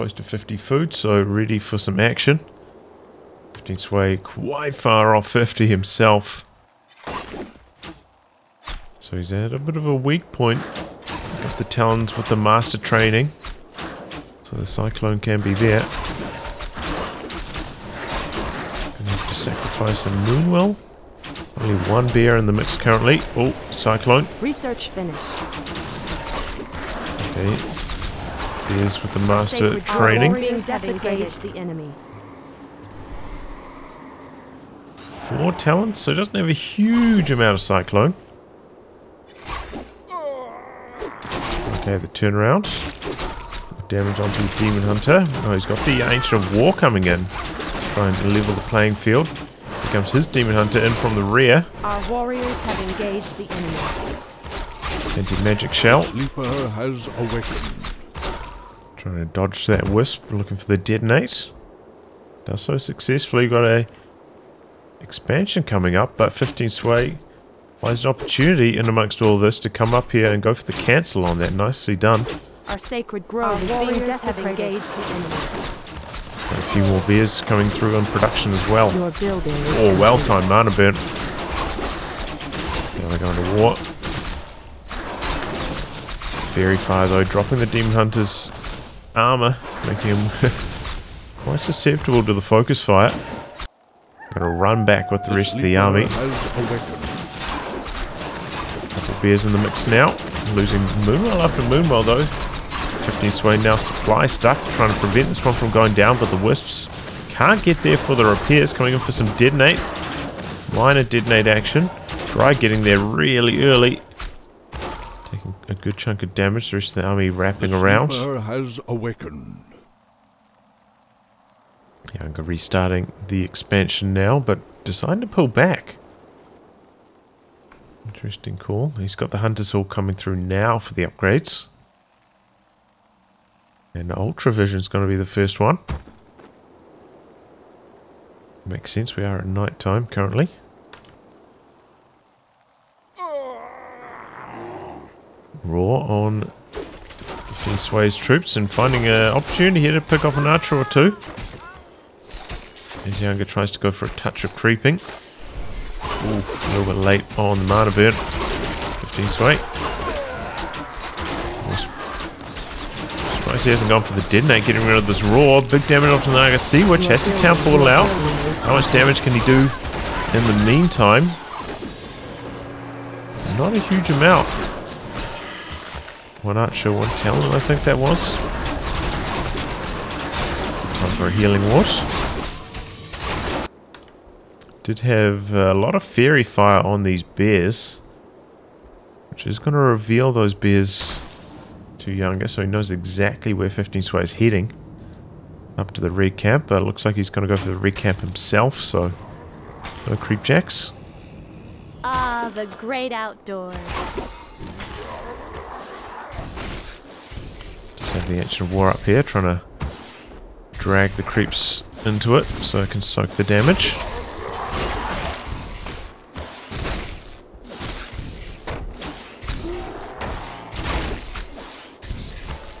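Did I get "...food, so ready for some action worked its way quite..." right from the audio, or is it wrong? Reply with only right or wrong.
right.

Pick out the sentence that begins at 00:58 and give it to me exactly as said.
Trying to dodge that Wisp, looking for the Detonate.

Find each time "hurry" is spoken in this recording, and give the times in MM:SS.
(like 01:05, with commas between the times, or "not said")
not said.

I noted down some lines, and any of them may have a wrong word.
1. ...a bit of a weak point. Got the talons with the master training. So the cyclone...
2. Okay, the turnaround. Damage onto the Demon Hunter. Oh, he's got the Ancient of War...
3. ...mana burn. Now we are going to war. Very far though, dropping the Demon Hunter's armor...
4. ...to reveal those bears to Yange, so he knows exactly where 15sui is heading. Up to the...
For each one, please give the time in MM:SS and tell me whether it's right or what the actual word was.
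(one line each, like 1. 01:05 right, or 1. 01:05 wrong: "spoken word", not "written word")
1. 00:09 right
2. 00:41 right
3. 01:20 right
4. 03:09 right.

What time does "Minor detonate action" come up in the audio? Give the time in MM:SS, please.
01:50.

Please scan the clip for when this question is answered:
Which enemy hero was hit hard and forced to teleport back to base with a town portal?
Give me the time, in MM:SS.
02:46.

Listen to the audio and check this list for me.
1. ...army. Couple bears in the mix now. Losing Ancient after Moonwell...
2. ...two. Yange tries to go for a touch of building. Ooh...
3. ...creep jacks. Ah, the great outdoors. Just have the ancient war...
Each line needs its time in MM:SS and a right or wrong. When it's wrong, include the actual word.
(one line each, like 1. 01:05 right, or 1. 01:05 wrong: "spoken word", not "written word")
1. 01:35 wrong: "Moonwell", not "Ancient"
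2. 02:30 wrong: "creeping", not "building"
3. 03:20 right.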